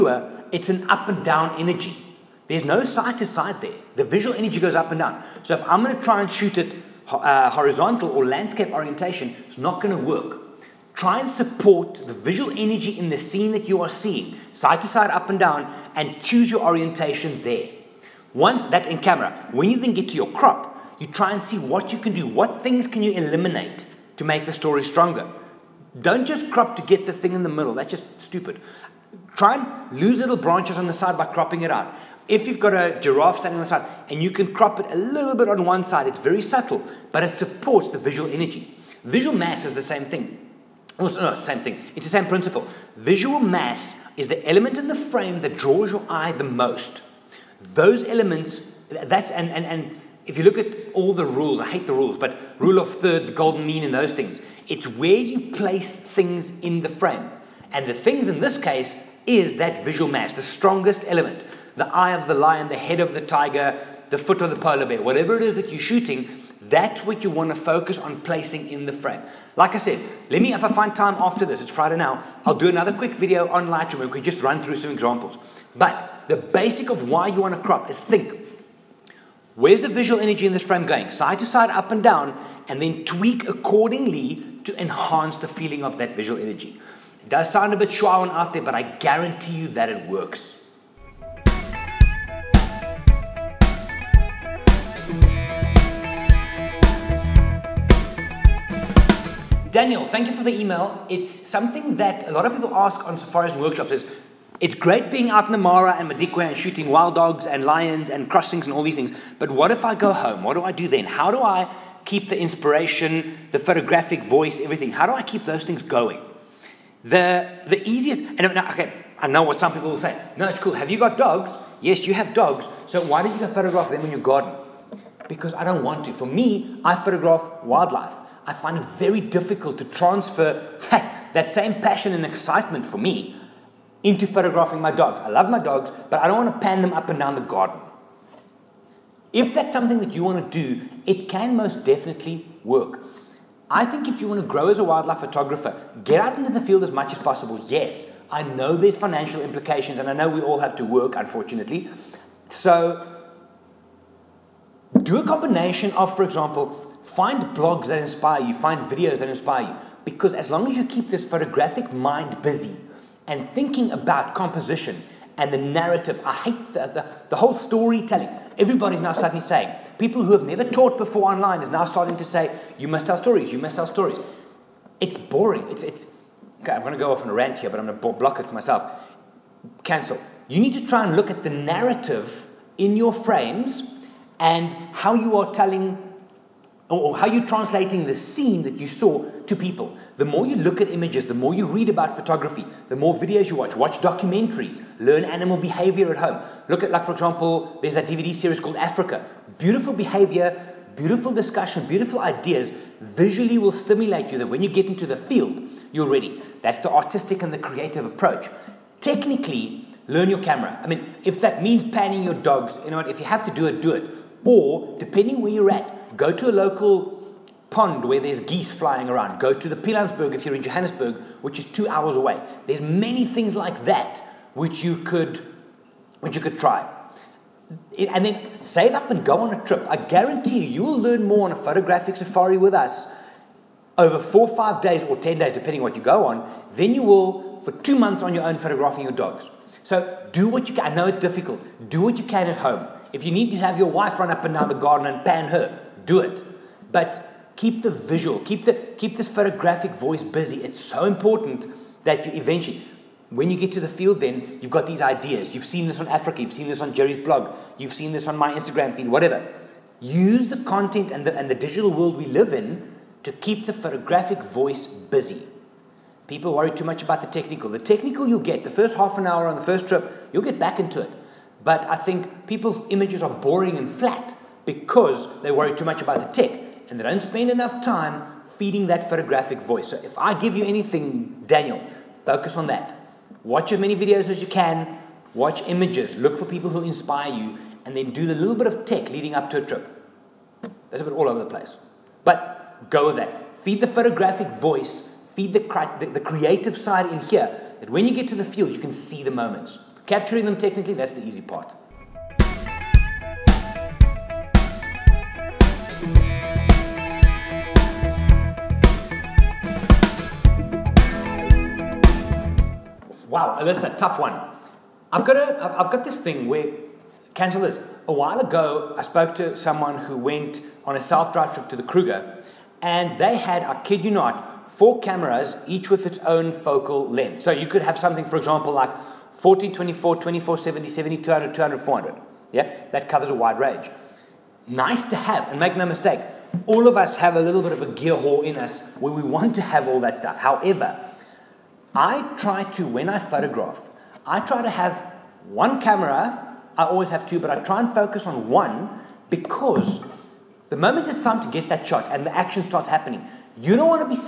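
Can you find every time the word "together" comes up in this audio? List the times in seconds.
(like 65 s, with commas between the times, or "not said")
not said.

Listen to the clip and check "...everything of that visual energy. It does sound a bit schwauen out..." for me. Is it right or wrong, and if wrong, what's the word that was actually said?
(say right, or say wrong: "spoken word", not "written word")
wrong: "feeling", not "everything".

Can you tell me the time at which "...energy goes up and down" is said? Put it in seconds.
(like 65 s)
4 s.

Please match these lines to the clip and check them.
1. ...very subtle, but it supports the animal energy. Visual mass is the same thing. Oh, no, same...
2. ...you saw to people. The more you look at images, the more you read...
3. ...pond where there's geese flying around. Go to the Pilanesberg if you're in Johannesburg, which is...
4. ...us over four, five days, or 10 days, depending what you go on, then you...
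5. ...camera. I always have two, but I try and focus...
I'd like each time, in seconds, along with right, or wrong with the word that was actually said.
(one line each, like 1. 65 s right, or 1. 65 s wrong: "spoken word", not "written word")
1. 36 s wrong: "visual", not "animal"
2. 188 s right
3. 217 s right
4. 232 s right
5. 345 s right.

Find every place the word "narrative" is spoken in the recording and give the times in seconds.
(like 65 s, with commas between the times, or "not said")
165 s, 181 s.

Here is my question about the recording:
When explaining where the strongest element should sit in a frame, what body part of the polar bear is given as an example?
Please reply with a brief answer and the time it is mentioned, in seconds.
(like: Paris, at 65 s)
Foot, at 64 s.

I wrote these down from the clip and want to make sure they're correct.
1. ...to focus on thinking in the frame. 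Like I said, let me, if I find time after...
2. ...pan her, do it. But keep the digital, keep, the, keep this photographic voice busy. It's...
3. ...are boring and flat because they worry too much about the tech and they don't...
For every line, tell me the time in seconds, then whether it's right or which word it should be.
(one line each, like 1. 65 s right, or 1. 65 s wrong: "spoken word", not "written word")
1. 67 s wrong: "placing", not "thinking"
2. 245 s wrong: "visual", not "digital"
3. 273 s right.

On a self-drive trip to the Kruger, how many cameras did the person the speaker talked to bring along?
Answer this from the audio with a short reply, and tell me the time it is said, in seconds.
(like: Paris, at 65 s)
4, at 324 s.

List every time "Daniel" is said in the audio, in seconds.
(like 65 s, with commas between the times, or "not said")
99 s, 281 s.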